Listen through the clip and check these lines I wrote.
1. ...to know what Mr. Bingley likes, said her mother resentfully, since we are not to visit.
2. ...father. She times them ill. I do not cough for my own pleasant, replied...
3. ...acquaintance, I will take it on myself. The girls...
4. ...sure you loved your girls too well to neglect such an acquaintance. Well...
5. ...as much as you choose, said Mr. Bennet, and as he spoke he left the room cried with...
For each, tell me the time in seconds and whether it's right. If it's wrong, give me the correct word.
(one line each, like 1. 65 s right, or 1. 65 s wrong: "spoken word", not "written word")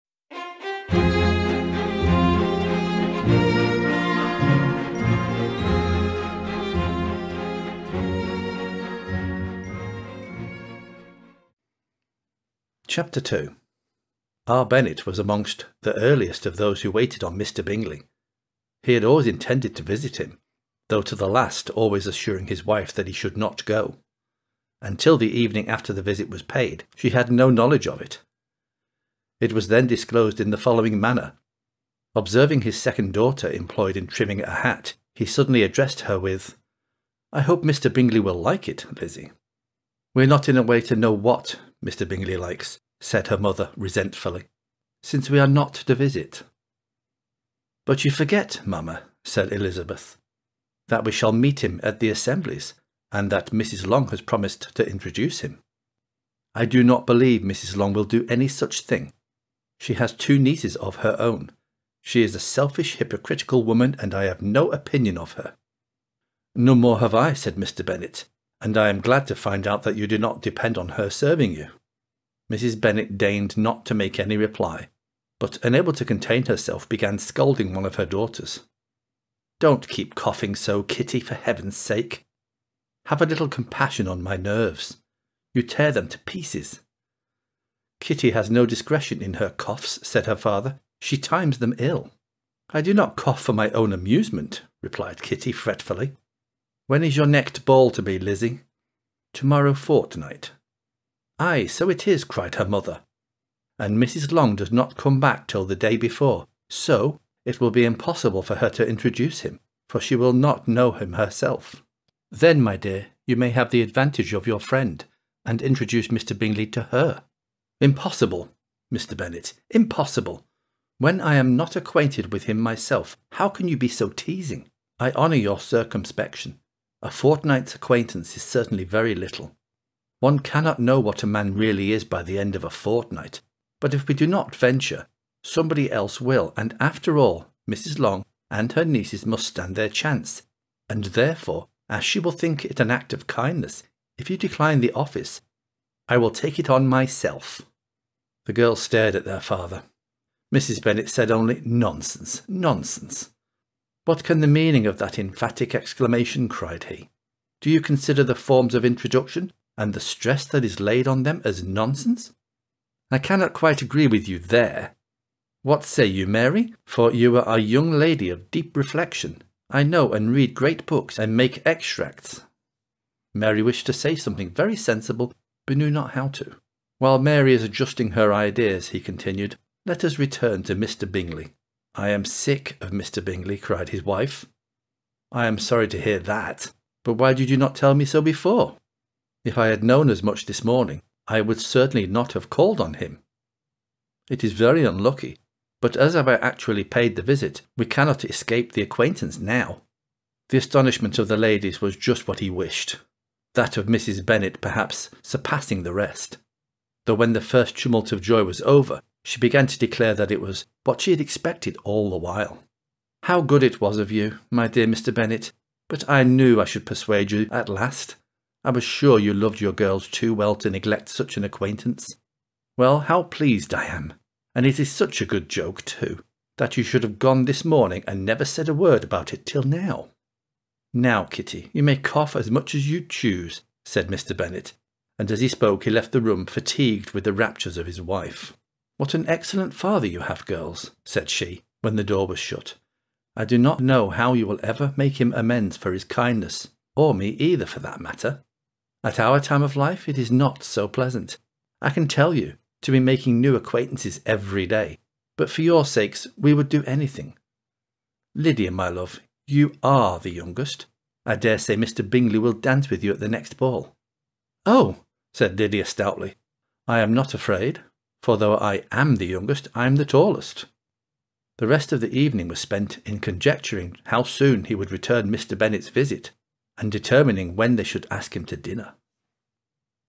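1. 40 s right
2. 90 s wrong: "amusement", not "pleasant"
3. 144 s wrong: "office", not "acquaintance"
4. 218 s right
5. 232 s wrong: "fatigued", not "cried".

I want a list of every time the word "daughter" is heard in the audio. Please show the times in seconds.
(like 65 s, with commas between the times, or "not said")
33 s, 78 s.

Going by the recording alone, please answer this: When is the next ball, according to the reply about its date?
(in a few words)
Tomorrow fortnight.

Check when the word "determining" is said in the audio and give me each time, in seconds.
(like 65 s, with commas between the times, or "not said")
276 s.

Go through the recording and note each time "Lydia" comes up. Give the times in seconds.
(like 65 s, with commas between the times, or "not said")
258 s, 265 s.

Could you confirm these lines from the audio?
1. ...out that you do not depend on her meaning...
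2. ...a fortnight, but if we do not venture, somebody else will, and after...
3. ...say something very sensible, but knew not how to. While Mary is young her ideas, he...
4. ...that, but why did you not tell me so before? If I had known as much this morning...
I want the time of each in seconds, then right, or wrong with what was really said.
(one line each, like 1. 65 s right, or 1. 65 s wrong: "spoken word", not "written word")
1. 69 s wrong: "serving", not "meaning"
2. 132 s right
3. 173 s wrong: "adjusting", not "young"
4. 186 s right.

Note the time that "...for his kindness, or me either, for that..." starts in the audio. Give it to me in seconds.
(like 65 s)
245 s.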